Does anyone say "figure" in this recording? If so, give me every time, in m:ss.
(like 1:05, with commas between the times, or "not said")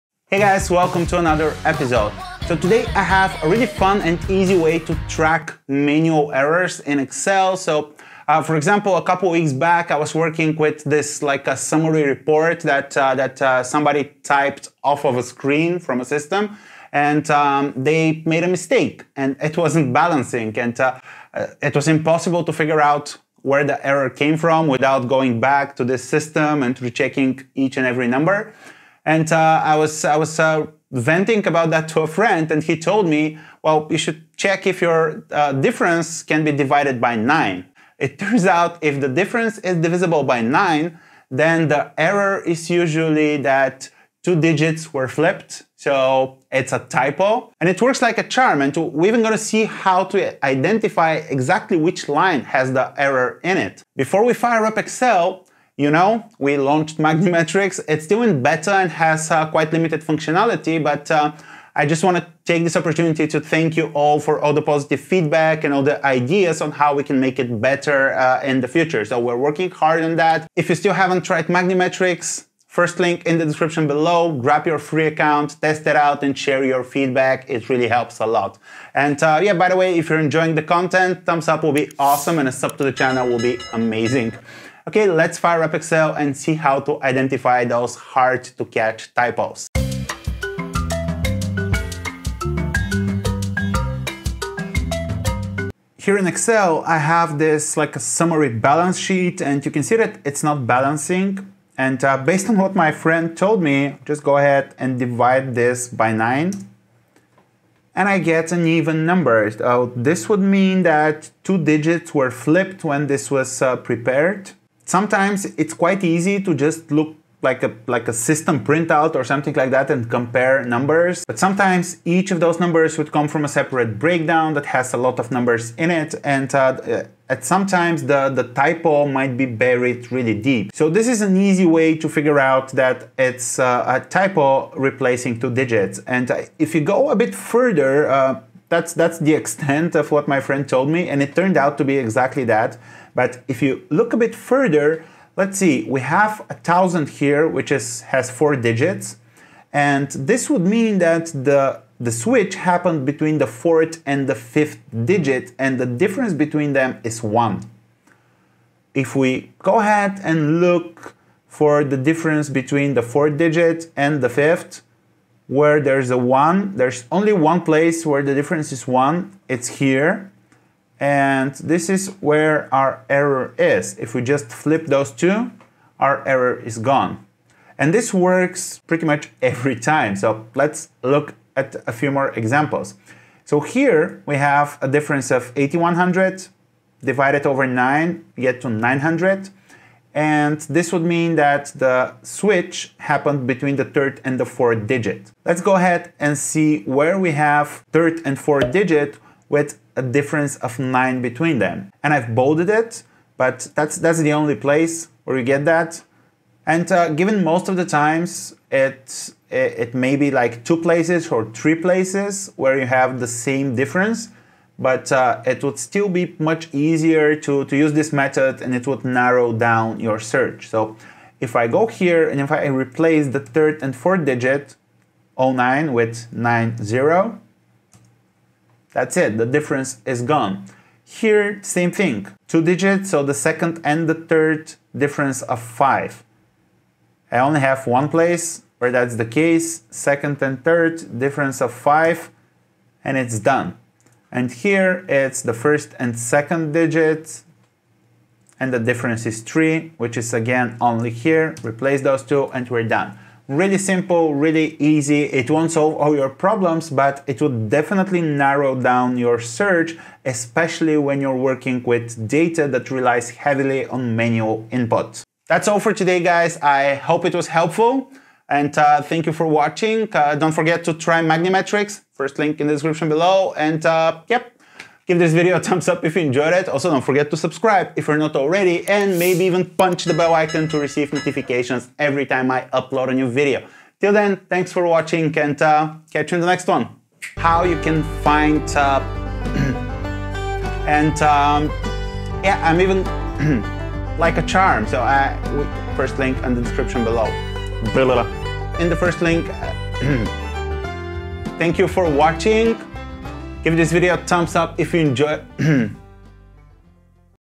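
0:22, 2:12.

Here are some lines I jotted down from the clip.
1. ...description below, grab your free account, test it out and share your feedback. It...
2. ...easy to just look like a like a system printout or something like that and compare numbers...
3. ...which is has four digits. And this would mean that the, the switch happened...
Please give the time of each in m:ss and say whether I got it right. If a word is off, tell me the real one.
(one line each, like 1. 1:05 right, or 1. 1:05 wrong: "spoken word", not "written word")
1. 1:13 right
2. 1:56 right
3. 2:27 right.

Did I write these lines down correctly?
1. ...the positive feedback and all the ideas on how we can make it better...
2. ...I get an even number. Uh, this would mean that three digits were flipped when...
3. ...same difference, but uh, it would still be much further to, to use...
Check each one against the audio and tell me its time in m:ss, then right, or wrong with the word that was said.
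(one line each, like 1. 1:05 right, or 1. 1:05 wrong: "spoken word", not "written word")
1. 1:04 right
2. 1:48 wrong: "two", not "three"
3. 3:33 wrong: "easier", not "further".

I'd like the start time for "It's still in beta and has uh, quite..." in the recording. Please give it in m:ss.
0:57.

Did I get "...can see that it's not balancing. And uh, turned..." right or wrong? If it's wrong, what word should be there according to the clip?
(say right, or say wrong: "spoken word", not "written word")
wrong: "based", not "turned".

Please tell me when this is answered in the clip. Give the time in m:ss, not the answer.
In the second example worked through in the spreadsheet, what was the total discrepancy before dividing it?
3:05.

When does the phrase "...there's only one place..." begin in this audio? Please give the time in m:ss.
2:46.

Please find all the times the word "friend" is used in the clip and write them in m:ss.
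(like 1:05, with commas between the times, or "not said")
0:32, 1:42, 2:20.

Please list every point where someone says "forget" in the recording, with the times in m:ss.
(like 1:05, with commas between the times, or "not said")
4:30, 4:37.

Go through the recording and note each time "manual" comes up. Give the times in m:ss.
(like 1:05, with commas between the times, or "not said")
0:05, 4:24.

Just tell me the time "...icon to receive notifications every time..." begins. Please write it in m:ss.
4:40.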